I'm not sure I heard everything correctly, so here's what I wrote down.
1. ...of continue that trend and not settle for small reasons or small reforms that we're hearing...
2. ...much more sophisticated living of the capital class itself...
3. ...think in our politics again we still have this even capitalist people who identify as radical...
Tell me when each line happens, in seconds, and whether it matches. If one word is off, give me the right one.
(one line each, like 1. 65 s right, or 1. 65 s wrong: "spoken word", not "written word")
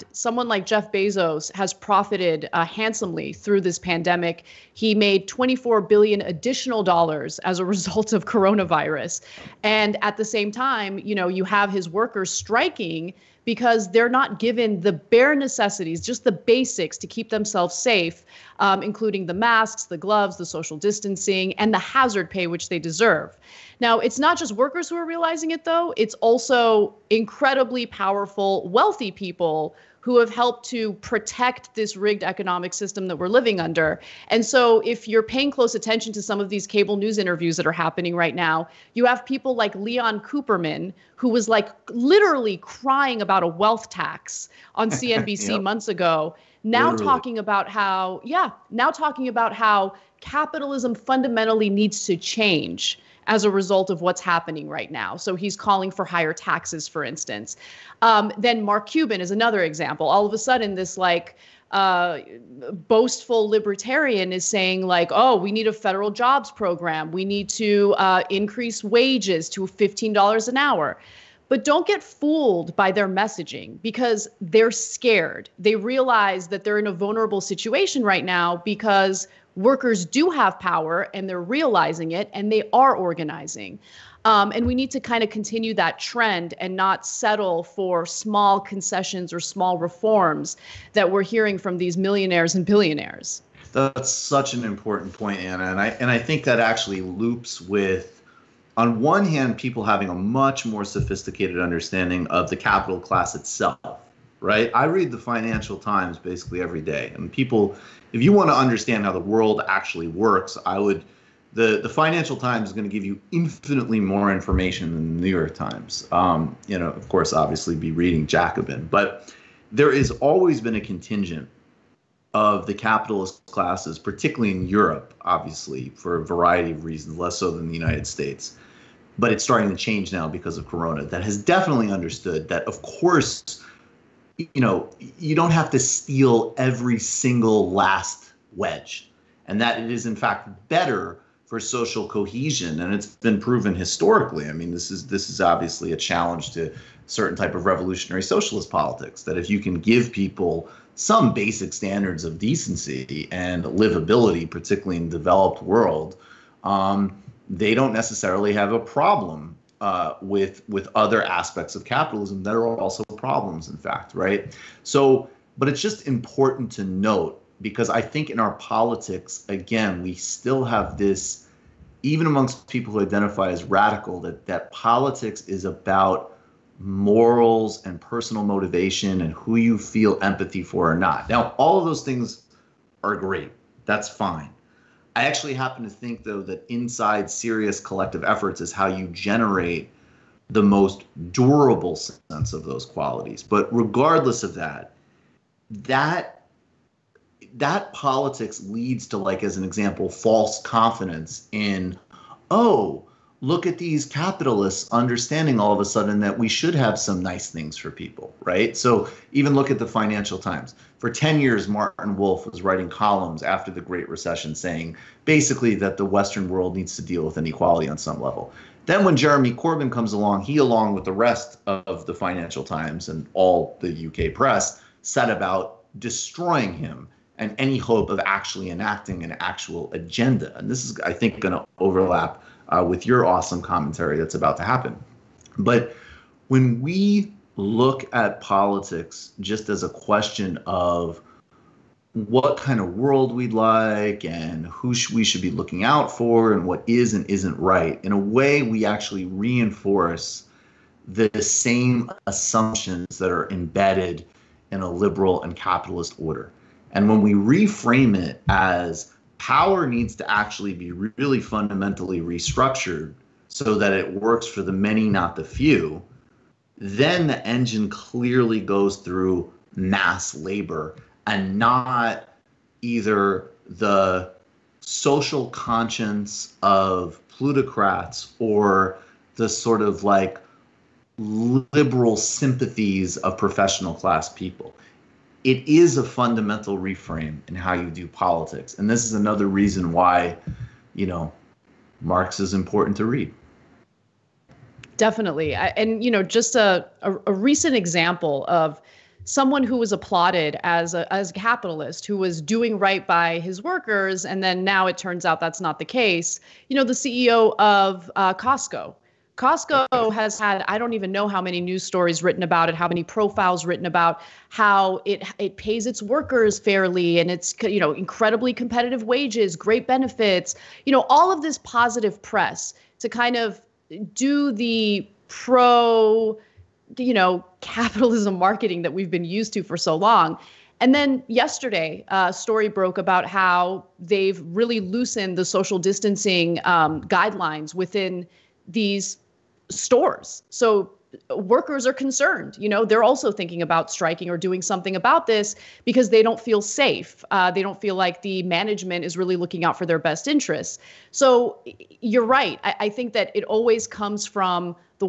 1. 85 s wrong: "concessions", not "reasons"
2. 100 s wrong: "understanding", not "living"
3. 167 s wrong: "amongst", not "capitalist".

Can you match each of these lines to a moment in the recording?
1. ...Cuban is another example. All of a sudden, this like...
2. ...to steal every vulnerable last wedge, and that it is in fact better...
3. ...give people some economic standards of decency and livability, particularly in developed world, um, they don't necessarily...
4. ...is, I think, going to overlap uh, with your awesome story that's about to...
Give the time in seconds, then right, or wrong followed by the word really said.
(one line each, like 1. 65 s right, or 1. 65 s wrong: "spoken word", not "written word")
1. 58 s right
2. 135 s wrong: "single", not "vulnerable"
3. 149 s wrong: "basic", not "economic"
4. 230 s wrong: "commentary", not "story".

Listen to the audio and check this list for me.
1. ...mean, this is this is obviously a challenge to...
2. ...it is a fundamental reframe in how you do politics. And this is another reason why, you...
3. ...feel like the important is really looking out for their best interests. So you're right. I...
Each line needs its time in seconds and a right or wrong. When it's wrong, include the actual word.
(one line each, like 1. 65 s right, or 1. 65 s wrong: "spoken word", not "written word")
1. 144 s right
2. 285 s right
3. 347 s wrong: "management", not "important".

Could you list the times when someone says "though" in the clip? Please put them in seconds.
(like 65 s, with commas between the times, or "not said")
25 s, 186 s.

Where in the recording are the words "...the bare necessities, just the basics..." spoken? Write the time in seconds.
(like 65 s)
14 s.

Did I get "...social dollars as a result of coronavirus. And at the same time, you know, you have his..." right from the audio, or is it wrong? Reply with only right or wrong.
wrong.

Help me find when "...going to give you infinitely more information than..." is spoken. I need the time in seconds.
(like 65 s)
112 s.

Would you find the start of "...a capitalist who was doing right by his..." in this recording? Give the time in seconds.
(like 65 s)
301 s.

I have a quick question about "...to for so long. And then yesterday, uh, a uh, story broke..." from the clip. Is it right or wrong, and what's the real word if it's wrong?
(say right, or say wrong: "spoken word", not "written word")
right.